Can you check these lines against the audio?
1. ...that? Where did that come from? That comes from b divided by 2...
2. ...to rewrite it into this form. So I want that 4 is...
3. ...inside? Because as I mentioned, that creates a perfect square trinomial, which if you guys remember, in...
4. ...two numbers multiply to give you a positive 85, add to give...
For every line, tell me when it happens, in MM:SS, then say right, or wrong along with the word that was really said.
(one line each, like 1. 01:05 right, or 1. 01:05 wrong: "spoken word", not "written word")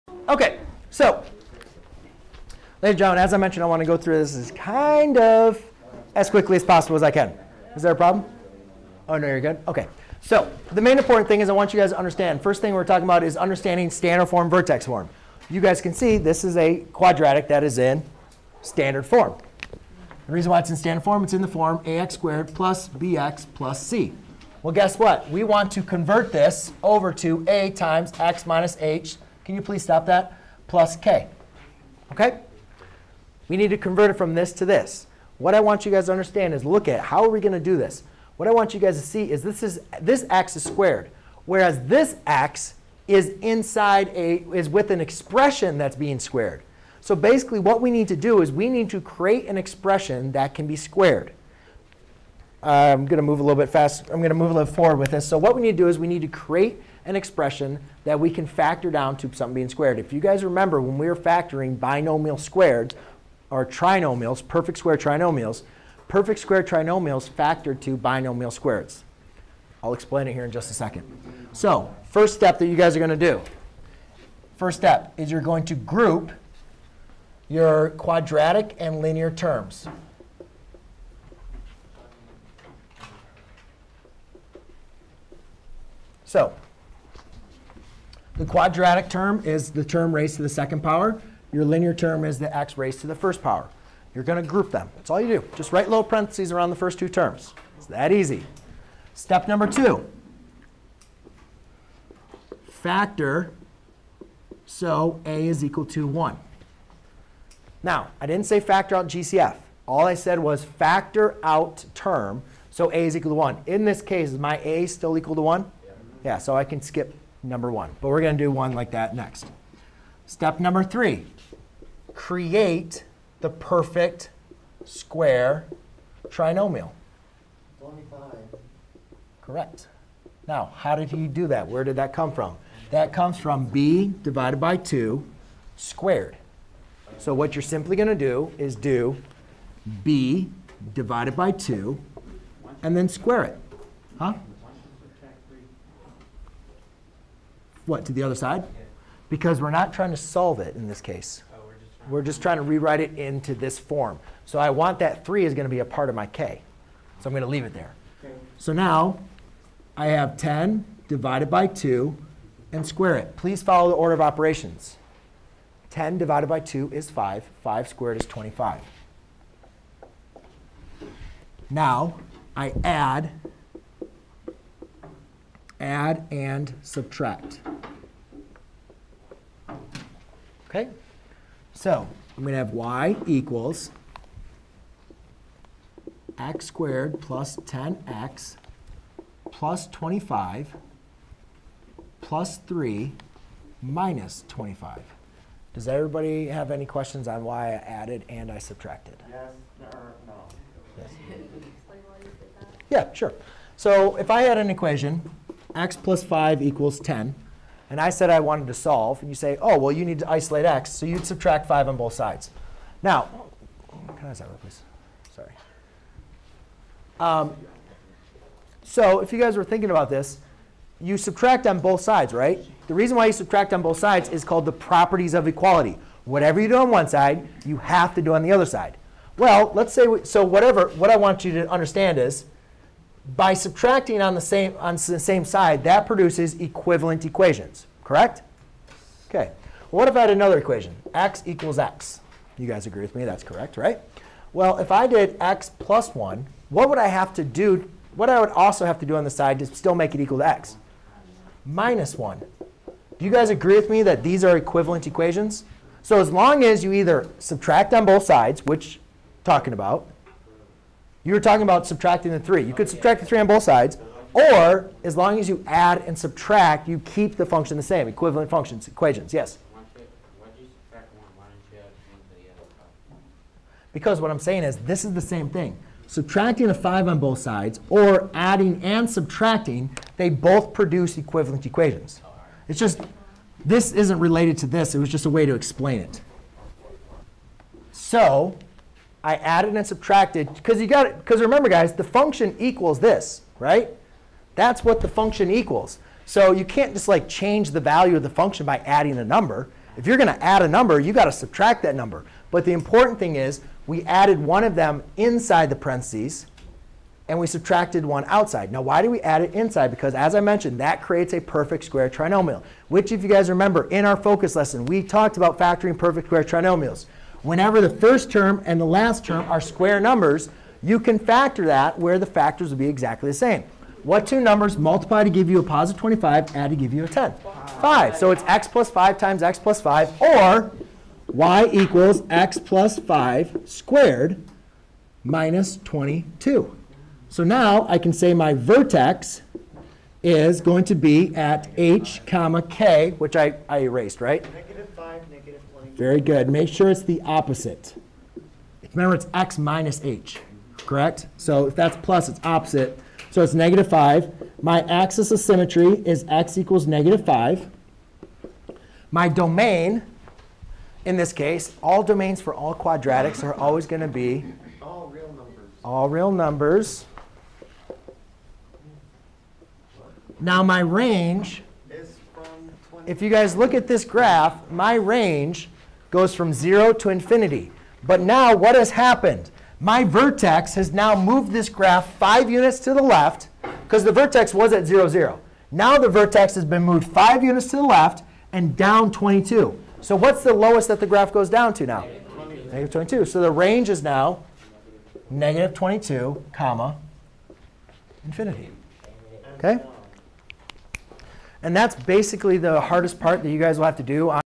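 1. 02:11 right
2. 02:32 wrong: "3", not "4"
3. 05:09 right
4. 05:24 wrong: "25", not "85".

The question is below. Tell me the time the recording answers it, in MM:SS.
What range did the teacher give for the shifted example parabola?
06:35.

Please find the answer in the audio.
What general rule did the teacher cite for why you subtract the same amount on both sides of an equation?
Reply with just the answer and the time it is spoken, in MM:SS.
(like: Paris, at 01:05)
properties of equality, at 03:44.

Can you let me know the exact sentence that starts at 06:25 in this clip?
Now the vertex has been moved five units to the left and down 22.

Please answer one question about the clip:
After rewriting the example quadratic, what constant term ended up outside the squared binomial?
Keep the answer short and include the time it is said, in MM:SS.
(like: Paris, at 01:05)
-22, at 05:35.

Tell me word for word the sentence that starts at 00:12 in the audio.
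First thing we're talking about is understanding standard form, vertex form.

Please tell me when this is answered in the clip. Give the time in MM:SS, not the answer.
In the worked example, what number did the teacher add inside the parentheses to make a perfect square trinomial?
02:07.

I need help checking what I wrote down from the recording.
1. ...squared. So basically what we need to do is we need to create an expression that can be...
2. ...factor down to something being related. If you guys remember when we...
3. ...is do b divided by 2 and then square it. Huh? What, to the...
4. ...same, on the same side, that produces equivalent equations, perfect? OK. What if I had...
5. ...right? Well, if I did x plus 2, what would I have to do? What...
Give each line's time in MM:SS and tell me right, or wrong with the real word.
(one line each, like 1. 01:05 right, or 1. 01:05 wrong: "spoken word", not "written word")
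1. 00:46 right
2. 00:58 wrong: "squared", not "related"
3. 02:18 right
4. 03:54 wrong: "correct", not "perfect"
5. 04:03 wrong: "1", not "2".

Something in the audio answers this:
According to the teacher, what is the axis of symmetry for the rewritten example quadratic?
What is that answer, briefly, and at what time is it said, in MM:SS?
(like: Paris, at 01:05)
x = -5, at 05:56.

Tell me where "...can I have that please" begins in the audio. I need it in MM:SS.
03:34.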